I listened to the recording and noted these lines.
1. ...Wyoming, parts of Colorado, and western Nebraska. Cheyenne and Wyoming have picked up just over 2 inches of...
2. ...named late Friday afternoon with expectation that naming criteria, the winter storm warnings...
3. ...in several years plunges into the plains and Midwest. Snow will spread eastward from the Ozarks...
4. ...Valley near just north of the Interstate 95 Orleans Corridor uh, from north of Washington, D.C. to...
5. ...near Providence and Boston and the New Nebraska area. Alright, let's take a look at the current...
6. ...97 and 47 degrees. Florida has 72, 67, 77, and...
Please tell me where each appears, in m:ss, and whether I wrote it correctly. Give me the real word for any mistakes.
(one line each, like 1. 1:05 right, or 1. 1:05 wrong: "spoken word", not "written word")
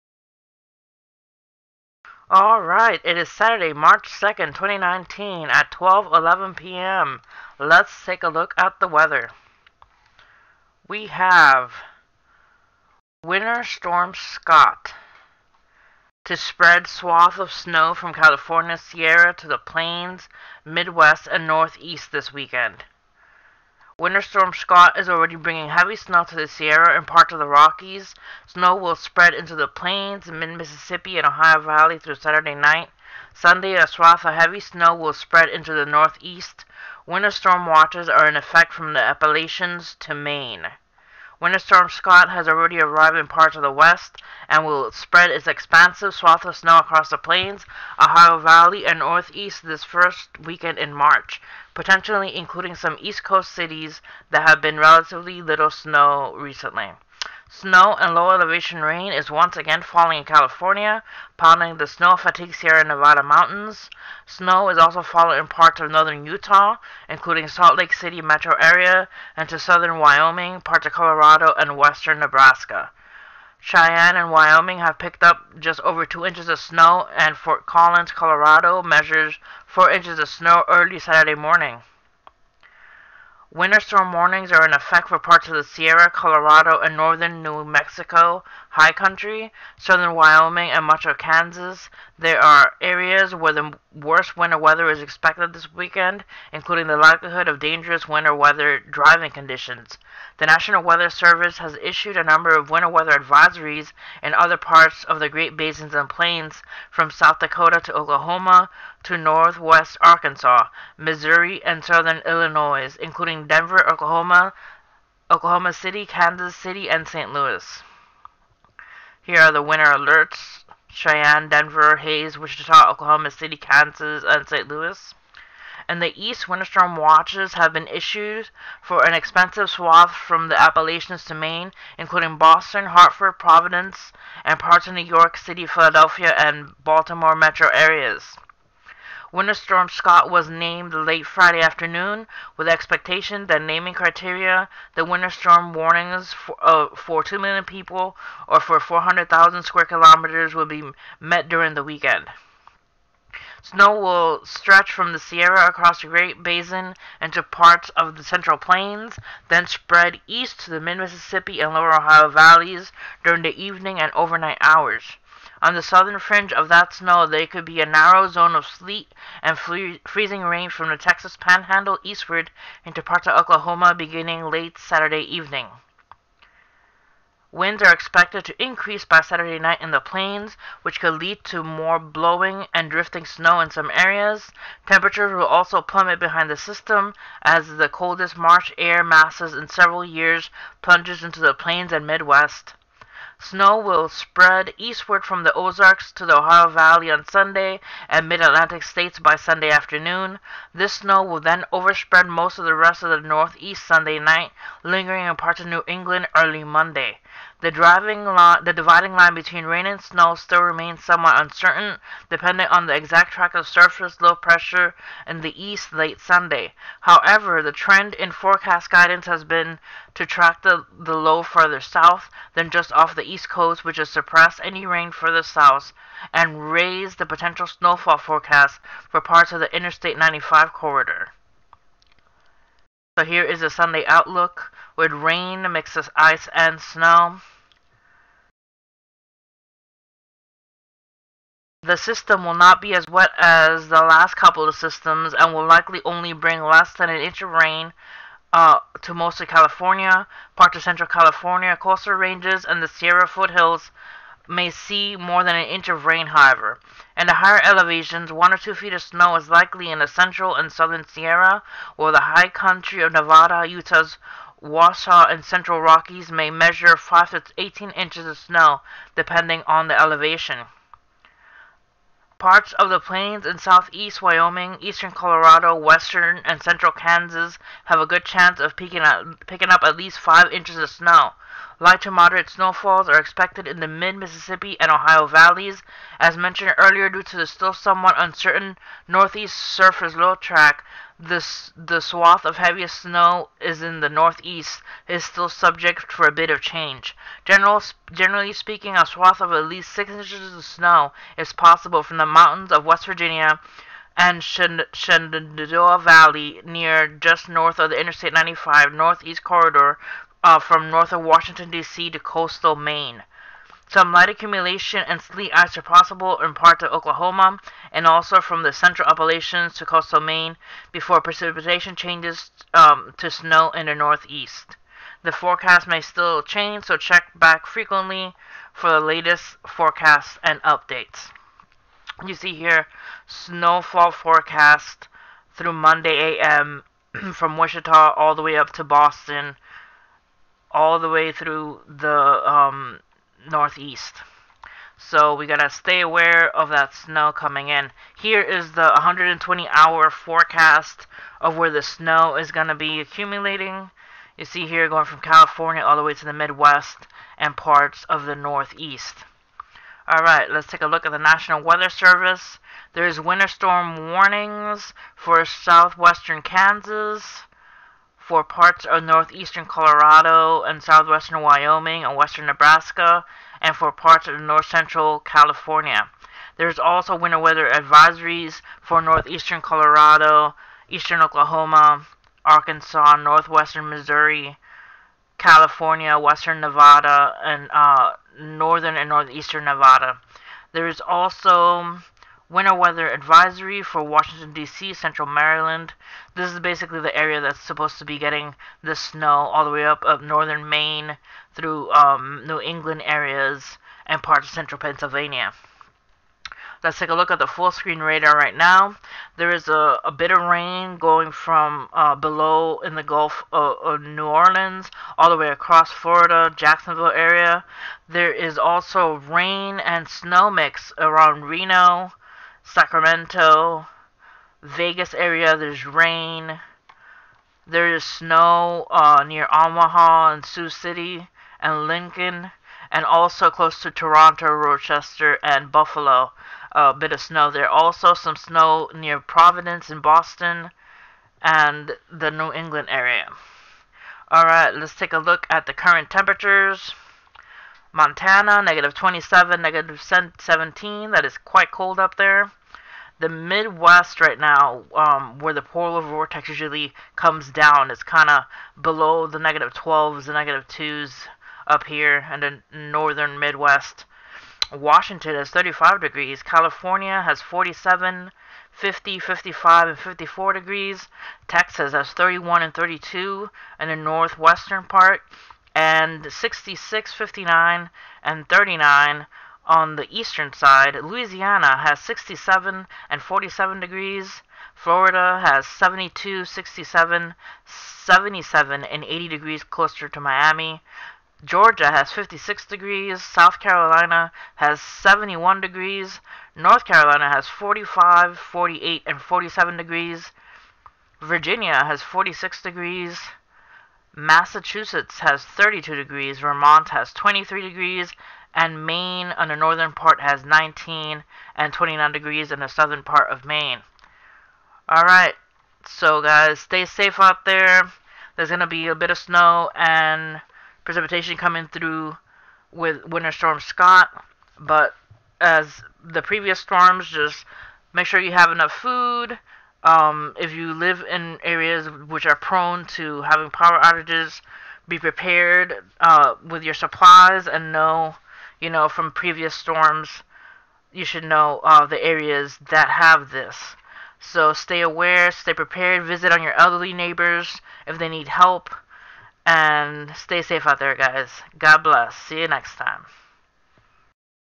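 1. 1:09 right
2. 2:20 right
3. 3:09 right
4. 5:05 wrong: "Northeast", not "Orleans"
5. 7:18 wrong: "England", not "Nebraska"
6. 8:01 wrong: "67", not "97".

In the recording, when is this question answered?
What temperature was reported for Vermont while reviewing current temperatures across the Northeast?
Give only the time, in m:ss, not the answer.
8:27.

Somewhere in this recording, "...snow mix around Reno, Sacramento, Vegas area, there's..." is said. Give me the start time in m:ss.
7:00.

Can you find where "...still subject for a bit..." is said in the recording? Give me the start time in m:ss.
4:55.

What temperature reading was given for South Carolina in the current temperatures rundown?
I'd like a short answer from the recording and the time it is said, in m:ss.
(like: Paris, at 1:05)
71 degrees, at 8:14.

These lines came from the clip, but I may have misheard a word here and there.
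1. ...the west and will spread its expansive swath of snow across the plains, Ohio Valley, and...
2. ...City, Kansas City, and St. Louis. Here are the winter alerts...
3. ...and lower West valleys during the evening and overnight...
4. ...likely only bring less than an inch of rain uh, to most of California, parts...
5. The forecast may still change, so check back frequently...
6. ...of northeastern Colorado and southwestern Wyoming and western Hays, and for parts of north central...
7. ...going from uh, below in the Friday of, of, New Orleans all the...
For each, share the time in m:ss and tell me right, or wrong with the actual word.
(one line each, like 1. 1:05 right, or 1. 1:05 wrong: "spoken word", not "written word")
1. 0:43 right
2. 1:55 right
3. 2:41 wrong: "Ohio", not "West"
4. 4:05 right
5. 5:25 right
6. 6:08 wrong: "Nebraska", not "Hays"
7. 6:50 wrong: "Gulf", not "Friday".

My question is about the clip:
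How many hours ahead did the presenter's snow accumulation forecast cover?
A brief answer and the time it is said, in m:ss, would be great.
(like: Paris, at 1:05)
120 hours, at 5:48.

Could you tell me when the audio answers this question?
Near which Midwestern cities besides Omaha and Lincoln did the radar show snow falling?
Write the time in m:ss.
7:10.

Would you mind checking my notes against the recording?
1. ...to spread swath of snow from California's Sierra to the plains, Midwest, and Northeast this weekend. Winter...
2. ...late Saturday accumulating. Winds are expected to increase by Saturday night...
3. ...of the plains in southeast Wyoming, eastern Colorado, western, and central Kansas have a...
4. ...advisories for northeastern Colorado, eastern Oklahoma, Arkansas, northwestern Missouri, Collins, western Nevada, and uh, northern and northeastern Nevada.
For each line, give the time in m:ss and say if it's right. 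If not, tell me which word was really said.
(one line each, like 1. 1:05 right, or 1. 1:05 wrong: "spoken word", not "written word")
1. 0:16 right
2. 2:54 wrong: "evening", not "accumulating"
3. 4:32 right
4. 6:17 wrong: "California", not "Collins".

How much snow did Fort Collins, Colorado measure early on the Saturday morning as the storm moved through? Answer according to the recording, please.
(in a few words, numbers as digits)
4 inches.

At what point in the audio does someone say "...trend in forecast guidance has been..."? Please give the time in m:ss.
3:37.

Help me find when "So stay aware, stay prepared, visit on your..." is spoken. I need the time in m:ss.
9:04.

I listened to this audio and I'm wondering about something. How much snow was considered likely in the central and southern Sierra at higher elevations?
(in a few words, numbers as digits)
one or two feet.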